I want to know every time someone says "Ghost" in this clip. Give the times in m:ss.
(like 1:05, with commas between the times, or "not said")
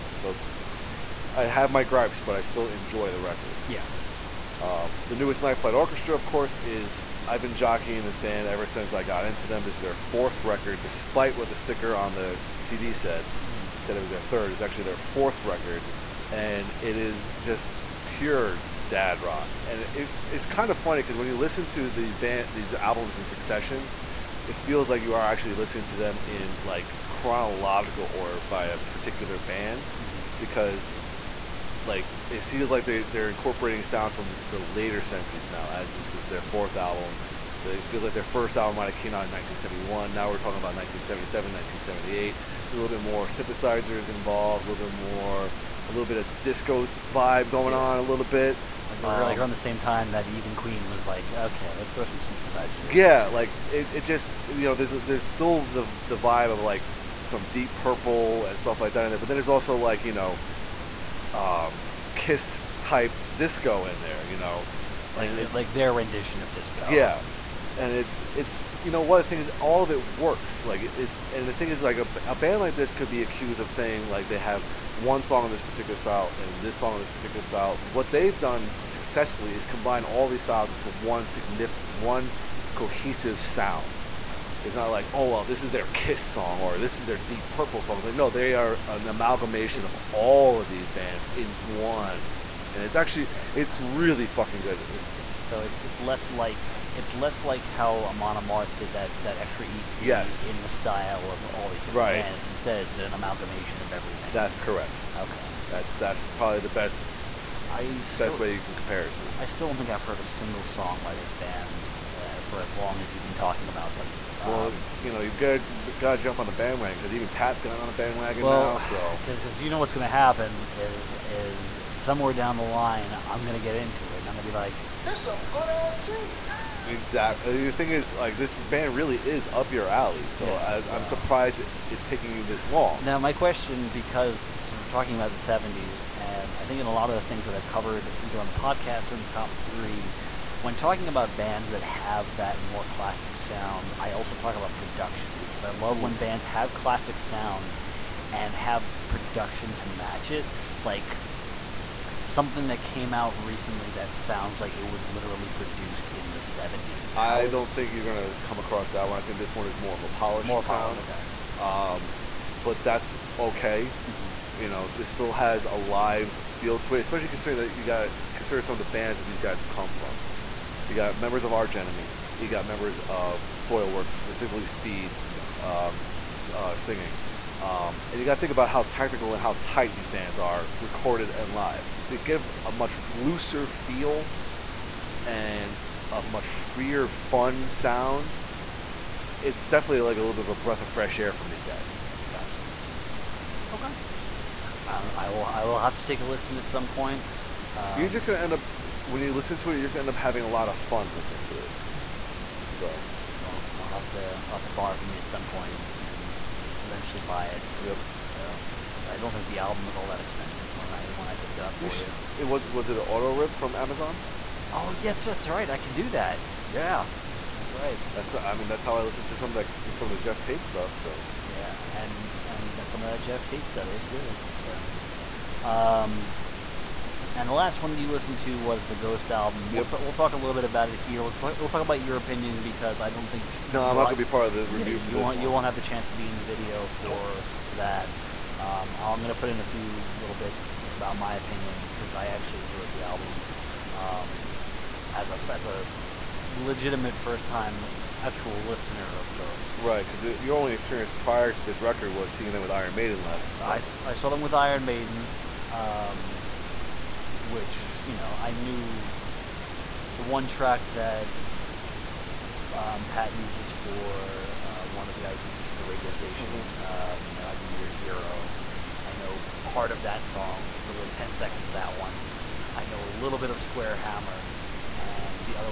3:48, 4:09.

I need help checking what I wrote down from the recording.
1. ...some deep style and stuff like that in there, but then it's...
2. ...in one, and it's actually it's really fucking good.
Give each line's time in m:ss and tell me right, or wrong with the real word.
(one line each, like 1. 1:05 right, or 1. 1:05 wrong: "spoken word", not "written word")
1. 0:57 wrong: "purple", not "style"
2. 1:31 right.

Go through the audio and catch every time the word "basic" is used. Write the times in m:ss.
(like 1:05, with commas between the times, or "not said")
not said.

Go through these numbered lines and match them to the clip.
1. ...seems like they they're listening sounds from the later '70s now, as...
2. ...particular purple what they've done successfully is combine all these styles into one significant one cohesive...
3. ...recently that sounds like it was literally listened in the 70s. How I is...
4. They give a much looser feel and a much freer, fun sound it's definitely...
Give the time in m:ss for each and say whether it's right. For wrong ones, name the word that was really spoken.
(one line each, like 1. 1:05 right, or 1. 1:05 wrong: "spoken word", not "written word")
1. 0:32 wrong: "incorporating", not "listening"
2. 1:17 wrong: "style", not "purple"
3. 2:33 wrong: "produced", not "listened"
4. 3:02 right.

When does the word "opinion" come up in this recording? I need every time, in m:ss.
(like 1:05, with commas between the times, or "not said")
3:52, 4:01.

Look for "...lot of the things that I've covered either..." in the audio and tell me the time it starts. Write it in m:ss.
2:16.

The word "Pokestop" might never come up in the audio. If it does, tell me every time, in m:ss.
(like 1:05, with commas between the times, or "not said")
not said.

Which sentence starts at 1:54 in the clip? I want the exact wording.
Well, um, you know, you've got got to jump on the bandwagon because even Pat's gotten on the bandwagon well, now.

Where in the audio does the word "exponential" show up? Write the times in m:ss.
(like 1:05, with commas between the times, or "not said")
not said.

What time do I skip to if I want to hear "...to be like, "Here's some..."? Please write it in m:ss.
2:04.